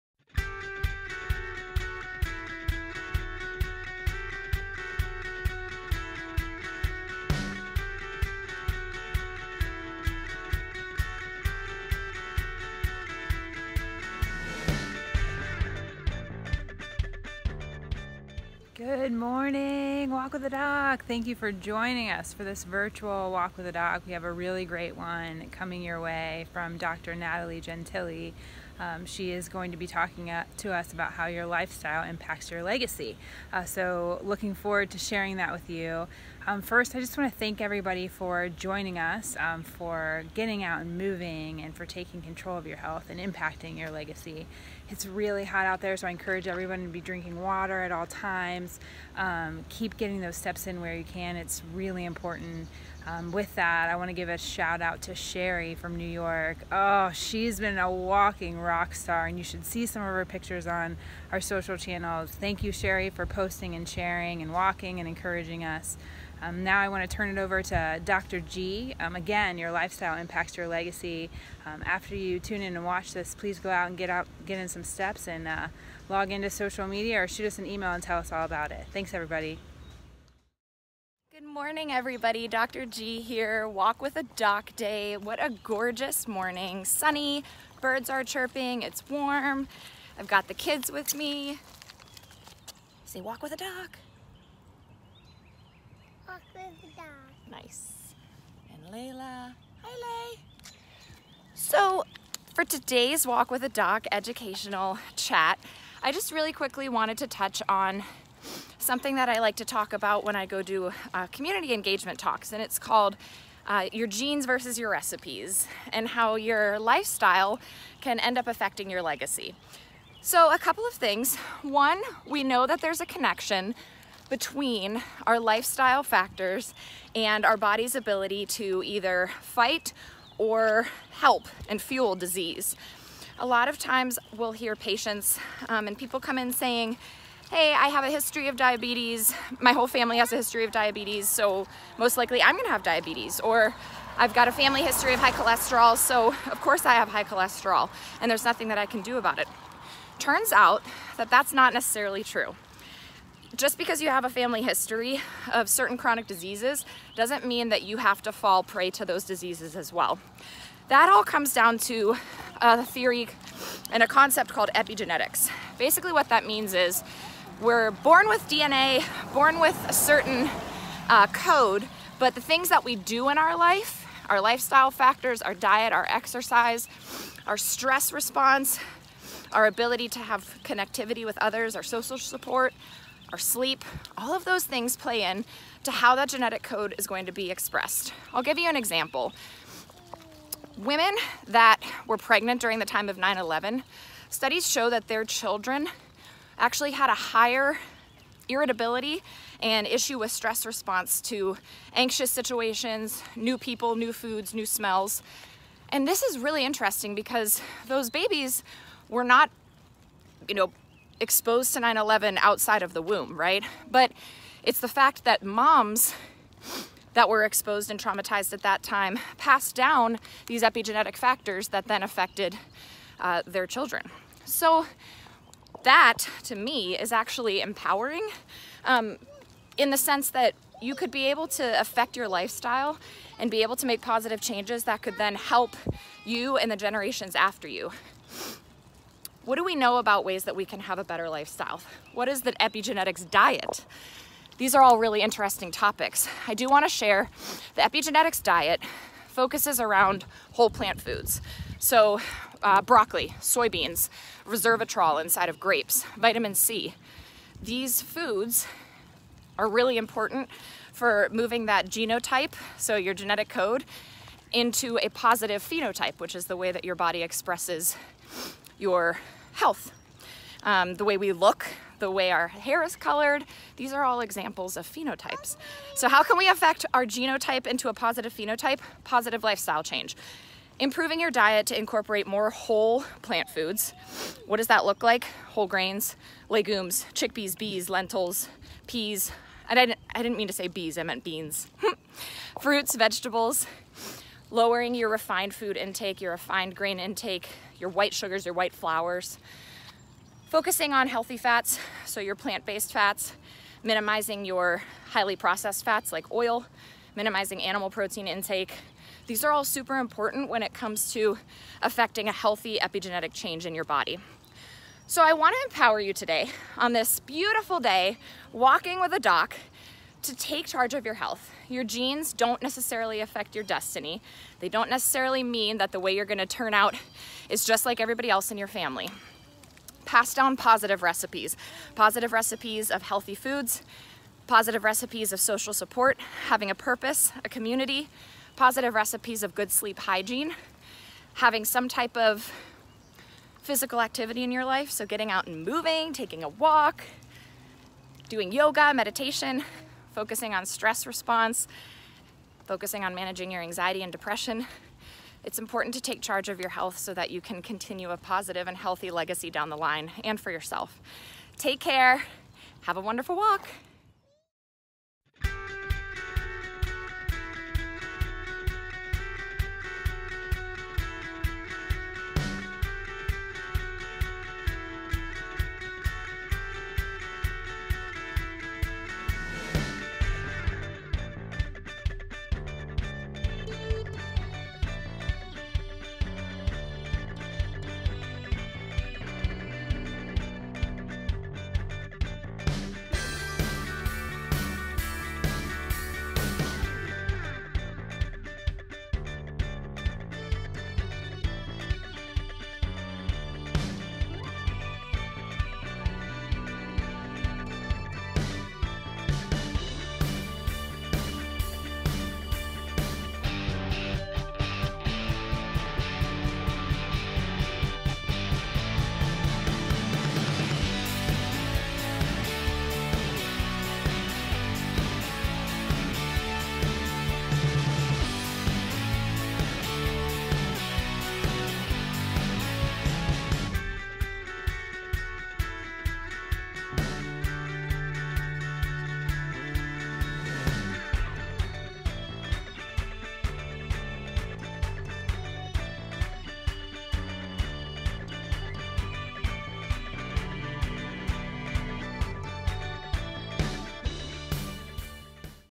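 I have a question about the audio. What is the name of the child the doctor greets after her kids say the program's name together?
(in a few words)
Layla.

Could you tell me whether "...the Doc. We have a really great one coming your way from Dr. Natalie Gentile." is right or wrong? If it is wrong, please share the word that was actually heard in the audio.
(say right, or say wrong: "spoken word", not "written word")
right.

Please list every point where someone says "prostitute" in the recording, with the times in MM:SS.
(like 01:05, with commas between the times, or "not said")
not said.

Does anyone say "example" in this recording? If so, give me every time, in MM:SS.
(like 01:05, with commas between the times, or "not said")
03:08, 04:34.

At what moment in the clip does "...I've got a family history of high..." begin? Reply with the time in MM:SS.
02:24.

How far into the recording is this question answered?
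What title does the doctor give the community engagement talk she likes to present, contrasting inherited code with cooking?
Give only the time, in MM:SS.
01:53.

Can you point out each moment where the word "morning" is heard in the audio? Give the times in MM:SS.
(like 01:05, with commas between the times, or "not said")
00:19, 01:21, 01:26.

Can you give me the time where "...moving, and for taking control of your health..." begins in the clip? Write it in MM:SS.
00:40.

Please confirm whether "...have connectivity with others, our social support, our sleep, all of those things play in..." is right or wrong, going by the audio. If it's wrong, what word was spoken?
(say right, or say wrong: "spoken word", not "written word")
right.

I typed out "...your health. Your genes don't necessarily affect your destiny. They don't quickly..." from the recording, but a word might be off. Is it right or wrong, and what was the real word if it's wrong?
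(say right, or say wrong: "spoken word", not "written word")
wrong: "necessarily", not "quickly".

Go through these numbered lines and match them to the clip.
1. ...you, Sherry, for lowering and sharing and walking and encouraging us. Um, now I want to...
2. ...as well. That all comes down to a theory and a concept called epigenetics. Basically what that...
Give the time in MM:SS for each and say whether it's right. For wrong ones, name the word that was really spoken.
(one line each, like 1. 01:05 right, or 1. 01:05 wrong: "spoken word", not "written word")
1. 01:02 wrong: "posting", not "lowering"
2. 02:39 right.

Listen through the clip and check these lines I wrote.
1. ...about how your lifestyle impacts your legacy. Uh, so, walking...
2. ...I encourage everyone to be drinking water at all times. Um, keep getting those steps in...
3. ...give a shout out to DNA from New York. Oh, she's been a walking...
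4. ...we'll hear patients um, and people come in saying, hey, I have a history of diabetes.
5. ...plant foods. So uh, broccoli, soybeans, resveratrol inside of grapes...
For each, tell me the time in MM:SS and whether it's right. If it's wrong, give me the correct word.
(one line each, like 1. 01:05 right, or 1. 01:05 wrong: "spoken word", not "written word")
1. 00:30 wrong: "looking", not "walking"
2. 00:46 right
3. 00:54 wrong: "Sherry", not "DNA"
4. 02:14 right
5. 04:10 right.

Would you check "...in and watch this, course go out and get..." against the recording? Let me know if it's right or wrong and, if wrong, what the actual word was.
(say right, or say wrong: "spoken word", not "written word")
wrong: "please", not "course".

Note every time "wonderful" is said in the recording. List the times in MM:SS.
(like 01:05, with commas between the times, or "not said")
06:03.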